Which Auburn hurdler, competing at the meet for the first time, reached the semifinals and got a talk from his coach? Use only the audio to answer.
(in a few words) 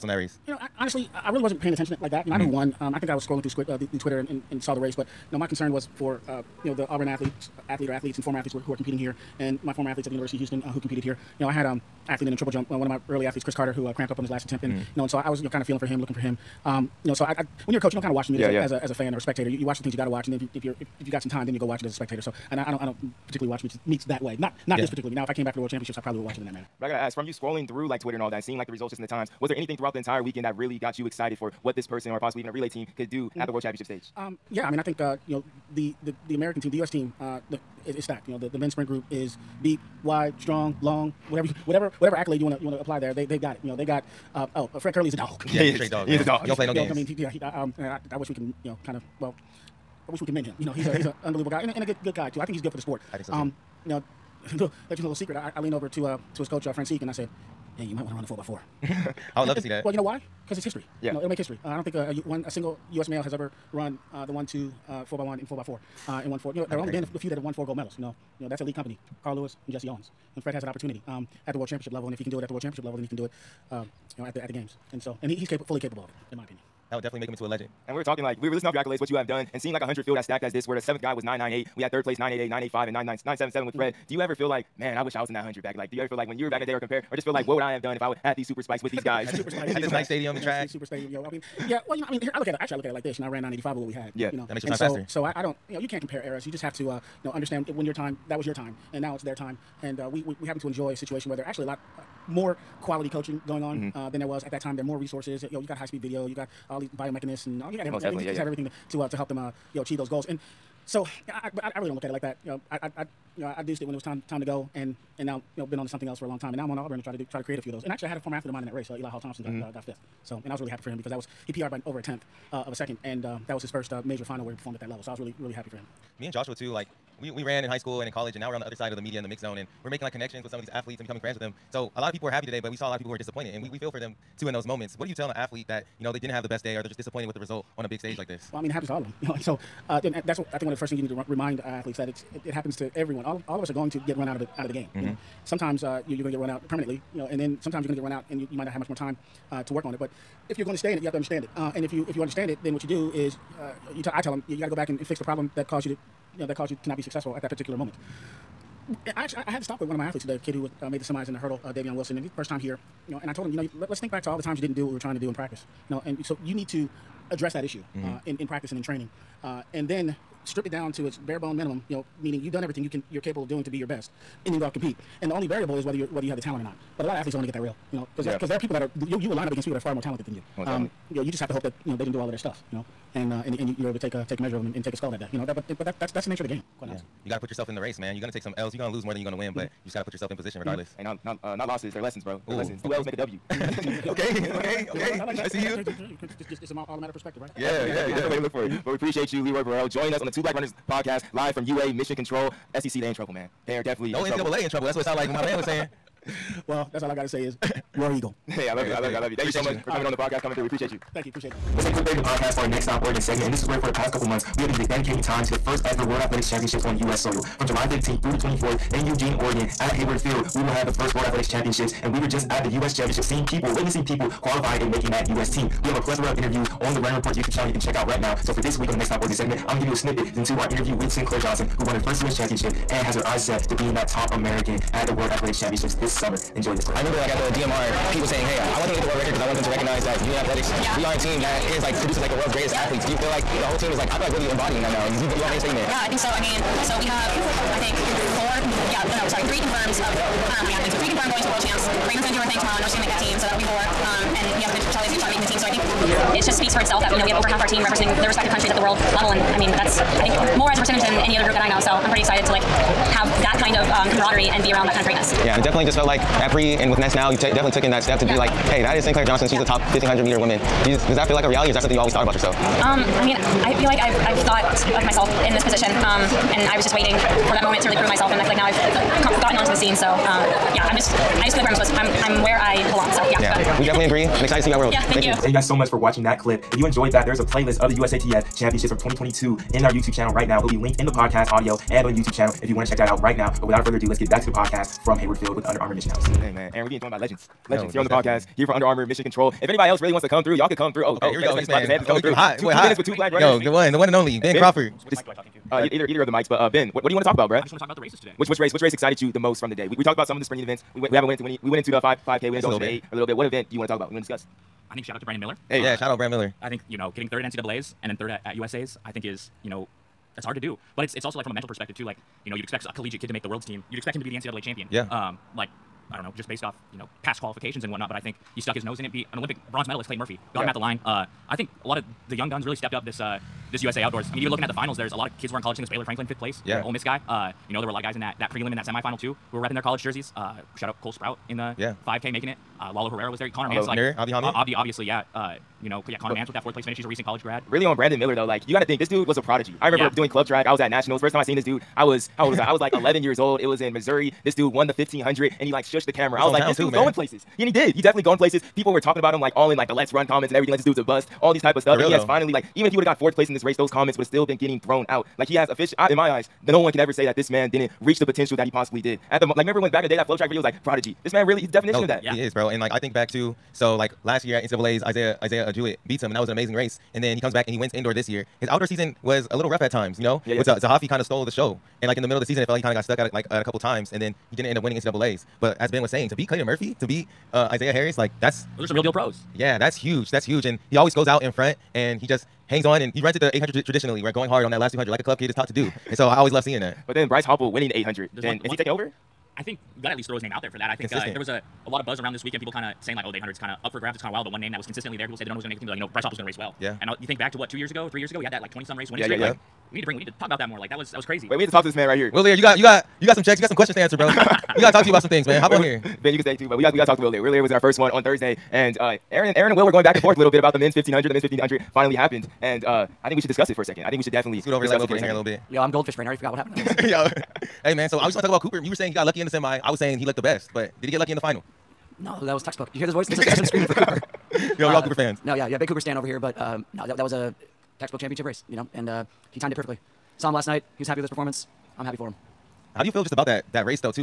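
Davion Wilson.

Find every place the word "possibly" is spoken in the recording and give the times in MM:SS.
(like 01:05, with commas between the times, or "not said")
00:32, 06:08.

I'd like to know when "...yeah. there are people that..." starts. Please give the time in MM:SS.
02:58.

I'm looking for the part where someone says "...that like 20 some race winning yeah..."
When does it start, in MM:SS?
06:48.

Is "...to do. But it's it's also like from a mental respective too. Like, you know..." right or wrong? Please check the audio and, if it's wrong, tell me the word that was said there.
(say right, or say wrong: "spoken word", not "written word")
wrong: "perspective", not "respective".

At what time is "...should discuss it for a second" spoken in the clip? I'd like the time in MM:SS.
07:03.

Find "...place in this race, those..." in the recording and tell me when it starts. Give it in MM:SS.
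06:03.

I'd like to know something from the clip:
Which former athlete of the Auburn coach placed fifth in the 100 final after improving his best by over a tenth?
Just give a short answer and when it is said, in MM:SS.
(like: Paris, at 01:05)
Eli Hall Thompson, at 01:58.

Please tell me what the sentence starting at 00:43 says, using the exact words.
You know, they've got uh, oh, uh, Fred Kerley is a dog.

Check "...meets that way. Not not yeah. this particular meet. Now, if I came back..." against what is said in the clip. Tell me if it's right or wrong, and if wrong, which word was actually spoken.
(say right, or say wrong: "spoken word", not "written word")
right.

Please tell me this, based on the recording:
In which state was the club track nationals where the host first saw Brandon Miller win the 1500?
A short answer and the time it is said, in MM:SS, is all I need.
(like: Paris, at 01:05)
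Missouri, at 05:53.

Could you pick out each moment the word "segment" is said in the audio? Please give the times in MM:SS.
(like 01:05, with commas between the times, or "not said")
03:33, 03:49.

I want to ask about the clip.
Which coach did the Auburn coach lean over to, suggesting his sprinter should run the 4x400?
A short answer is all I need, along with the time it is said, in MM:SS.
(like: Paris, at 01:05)
Francique, at 00:56.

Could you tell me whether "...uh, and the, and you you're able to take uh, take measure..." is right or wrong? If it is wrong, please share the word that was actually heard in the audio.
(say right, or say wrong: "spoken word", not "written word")
right.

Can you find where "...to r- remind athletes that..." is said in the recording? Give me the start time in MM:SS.
02:21.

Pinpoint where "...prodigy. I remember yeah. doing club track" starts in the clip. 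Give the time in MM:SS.
05:49.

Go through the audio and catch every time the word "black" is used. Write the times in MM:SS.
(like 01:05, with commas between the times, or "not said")
03:20, 05:03.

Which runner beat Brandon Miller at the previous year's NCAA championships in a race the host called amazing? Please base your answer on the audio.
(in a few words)
Isaiah Jewett.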